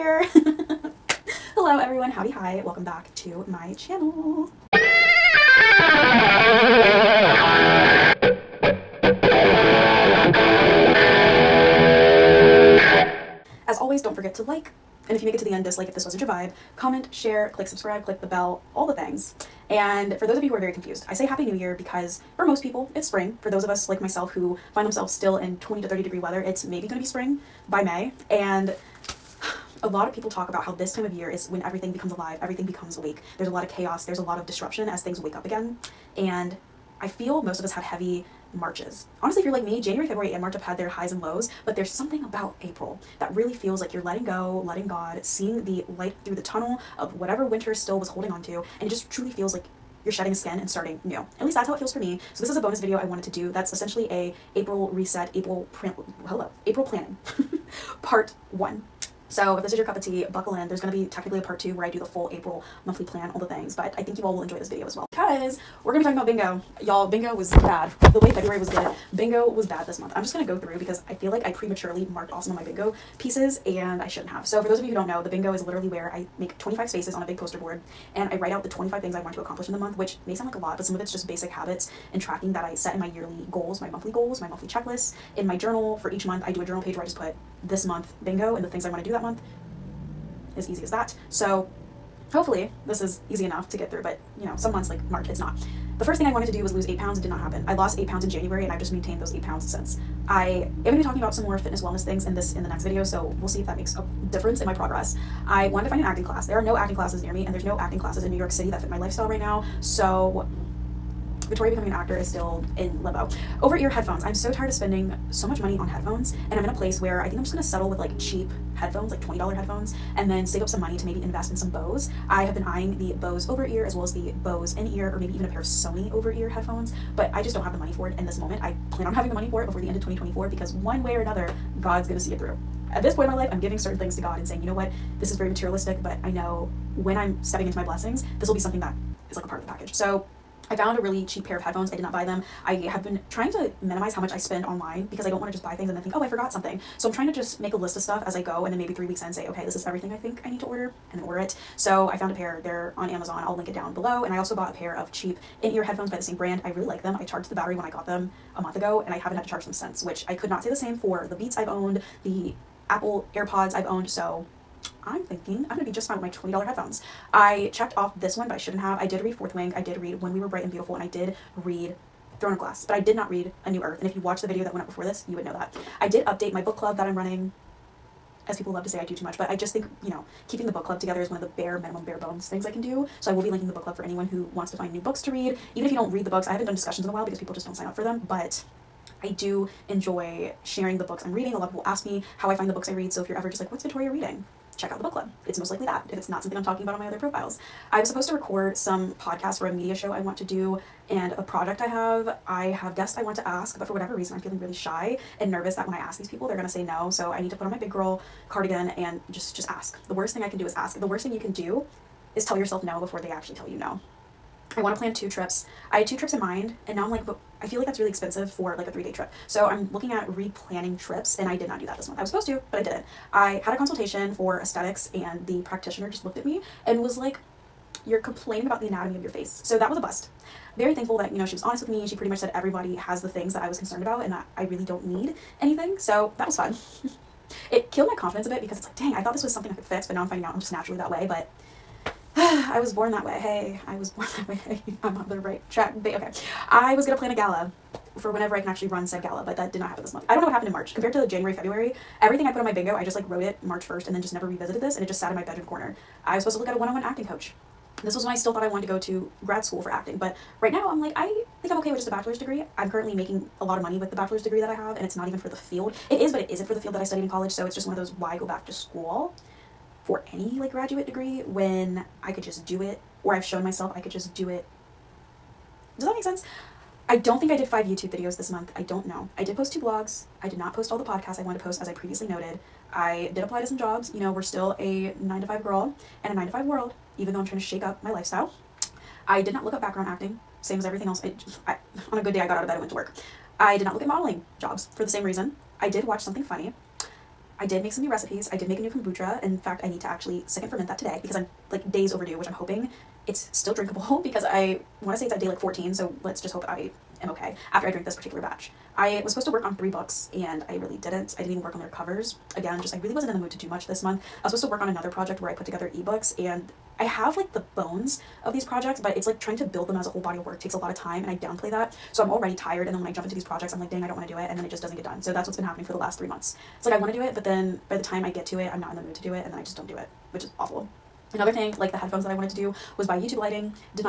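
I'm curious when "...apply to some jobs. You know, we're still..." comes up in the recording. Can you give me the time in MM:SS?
04:43.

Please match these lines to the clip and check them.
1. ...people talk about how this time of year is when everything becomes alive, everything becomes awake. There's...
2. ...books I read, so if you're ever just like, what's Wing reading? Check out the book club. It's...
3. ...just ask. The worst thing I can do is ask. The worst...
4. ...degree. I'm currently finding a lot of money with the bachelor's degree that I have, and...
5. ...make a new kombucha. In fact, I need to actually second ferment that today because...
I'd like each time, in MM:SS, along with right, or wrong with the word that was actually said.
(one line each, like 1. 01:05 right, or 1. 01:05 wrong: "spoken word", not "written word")
1. 00:30 right
2. 03:12 wrong: "Vittoria", not "Wing"
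3. 03:29 right
4. 04:22 wrong: "making", not "finding"
5. 04:58 right.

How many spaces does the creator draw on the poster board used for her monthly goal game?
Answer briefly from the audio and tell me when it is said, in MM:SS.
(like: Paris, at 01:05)
25, at 01:16.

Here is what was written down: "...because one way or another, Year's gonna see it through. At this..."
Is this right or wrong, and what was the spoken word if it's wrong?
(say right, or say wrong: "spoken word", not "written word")
wrong: "God", not "Year".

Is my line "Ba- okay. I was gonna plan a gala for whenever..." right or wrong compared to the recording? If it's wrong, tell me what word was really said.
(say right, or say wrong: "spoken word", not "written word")
right.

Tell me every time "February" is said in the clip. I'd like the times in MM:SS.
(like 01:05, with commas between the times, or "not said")
00:40, 01:08, 04:11.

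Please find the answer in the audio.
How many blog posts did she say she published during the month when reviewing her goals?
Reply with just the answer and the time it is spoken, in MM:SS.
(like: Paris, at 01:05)
2, at 04:39.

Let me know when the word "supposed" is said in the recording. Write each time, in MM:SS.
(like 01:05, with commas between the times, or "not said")
03:18, 03:42, 04:16, 05:09, 05:14.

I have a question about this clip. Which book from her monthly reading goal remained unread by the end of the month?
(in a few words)
A New Earth.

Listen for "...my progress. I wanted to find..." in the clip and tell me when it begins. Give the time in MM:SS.
01:44.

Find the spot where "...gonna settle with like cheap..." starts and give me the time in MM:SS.
01:57.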